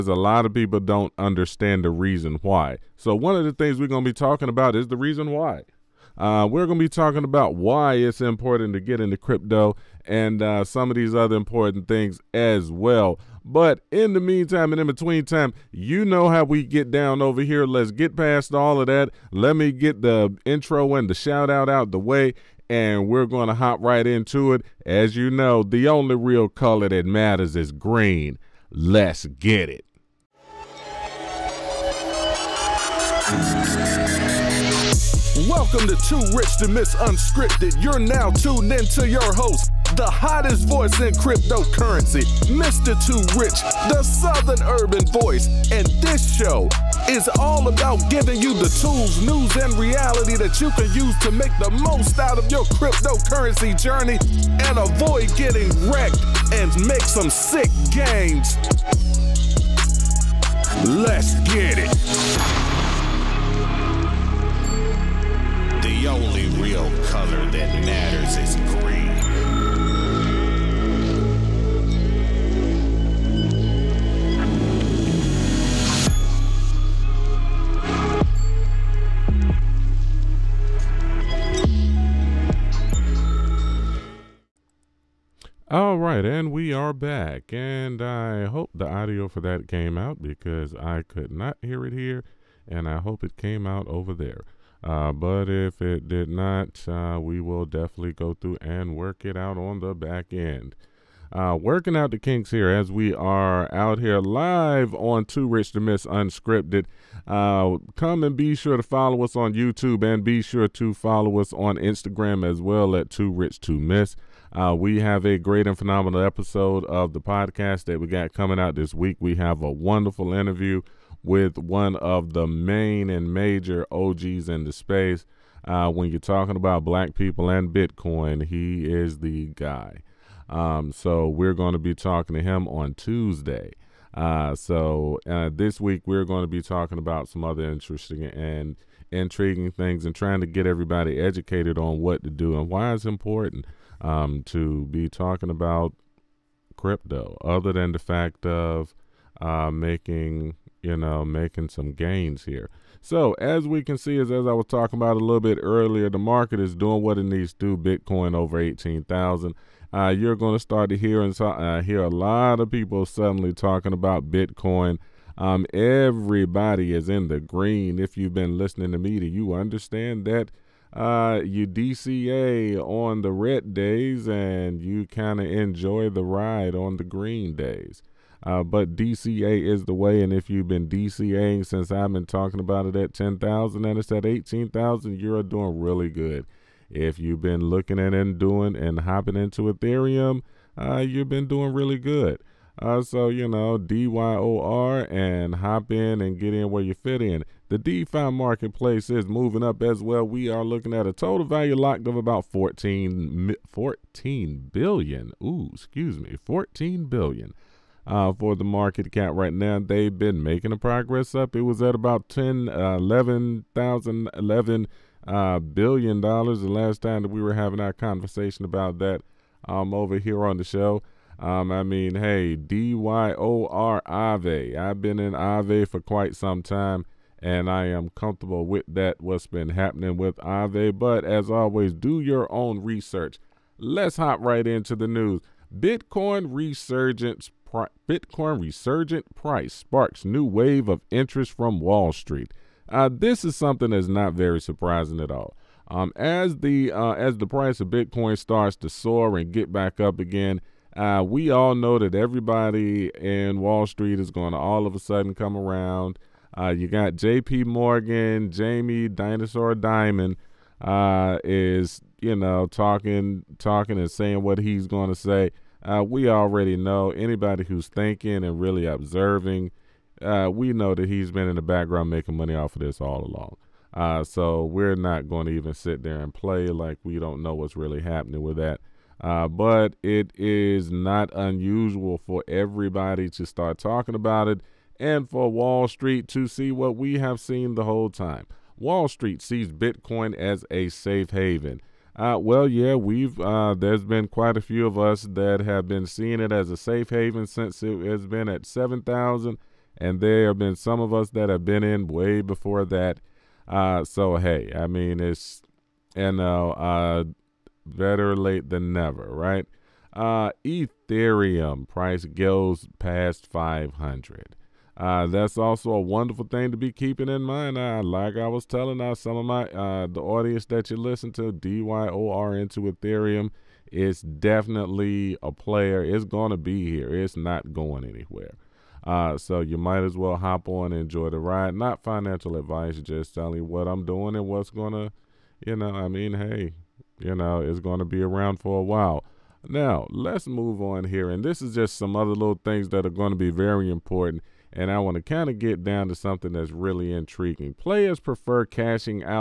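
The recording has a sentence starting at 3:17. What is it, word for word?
The DeFi marketplace is moving up as well.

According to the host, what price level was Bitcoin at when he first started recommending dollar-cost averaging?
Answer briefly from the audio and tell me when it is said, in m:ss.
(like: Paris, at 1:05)
10,000, at 3:03.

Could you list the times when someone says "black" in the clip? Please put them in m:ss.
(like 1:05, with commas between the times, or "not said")
2:06.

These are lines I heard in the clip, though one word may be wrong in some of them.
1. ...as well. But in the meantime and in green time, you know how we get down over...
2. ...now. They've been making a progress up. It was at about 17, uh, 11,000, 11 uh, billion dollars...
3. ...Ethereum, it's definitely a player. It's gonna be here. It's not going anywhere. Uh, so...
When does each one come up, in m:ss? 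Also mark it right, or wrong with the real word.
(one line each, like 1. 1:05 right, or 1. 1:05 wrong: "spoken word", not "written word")
1. 0:12 wrong: "between", not "green"
2. 3:29 wrong: "10", not "17"
3. 5:22 right.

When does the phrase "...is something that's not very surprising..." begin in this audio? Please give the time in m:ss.
4:03.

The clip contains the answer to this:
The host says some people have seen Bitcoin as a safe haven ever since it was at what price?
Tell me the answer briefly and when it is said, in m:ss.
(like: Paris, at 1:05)
7,000, at 4:58.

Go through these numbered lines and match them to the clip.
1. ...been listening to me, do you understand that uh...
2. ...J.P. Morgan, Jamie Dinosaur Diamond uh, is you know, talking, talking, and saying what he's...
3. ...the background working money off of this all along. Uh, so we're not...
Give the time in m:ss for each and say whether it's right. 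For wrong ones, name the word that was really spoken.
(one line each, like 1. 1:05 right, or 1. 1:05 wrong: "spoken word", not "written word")
1. 2:48 right
2. 4:17 right
3. 4:31 wrong: "making", not "working".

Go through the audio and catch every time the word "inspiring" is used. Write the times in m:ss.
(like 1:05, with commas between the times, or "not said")
not said.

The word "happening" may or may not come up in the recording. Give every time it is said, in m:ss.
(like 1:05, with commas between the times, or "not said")
3:49, 4:38.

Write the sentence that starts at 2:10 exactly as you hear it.
Um, so we're going to be talking to him on Tuesday.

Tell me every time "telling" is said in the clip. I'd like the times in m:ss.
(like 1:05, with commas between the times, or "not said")
5:18, 5:33.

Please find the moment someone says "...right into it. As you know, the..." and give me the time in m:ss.
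0:23.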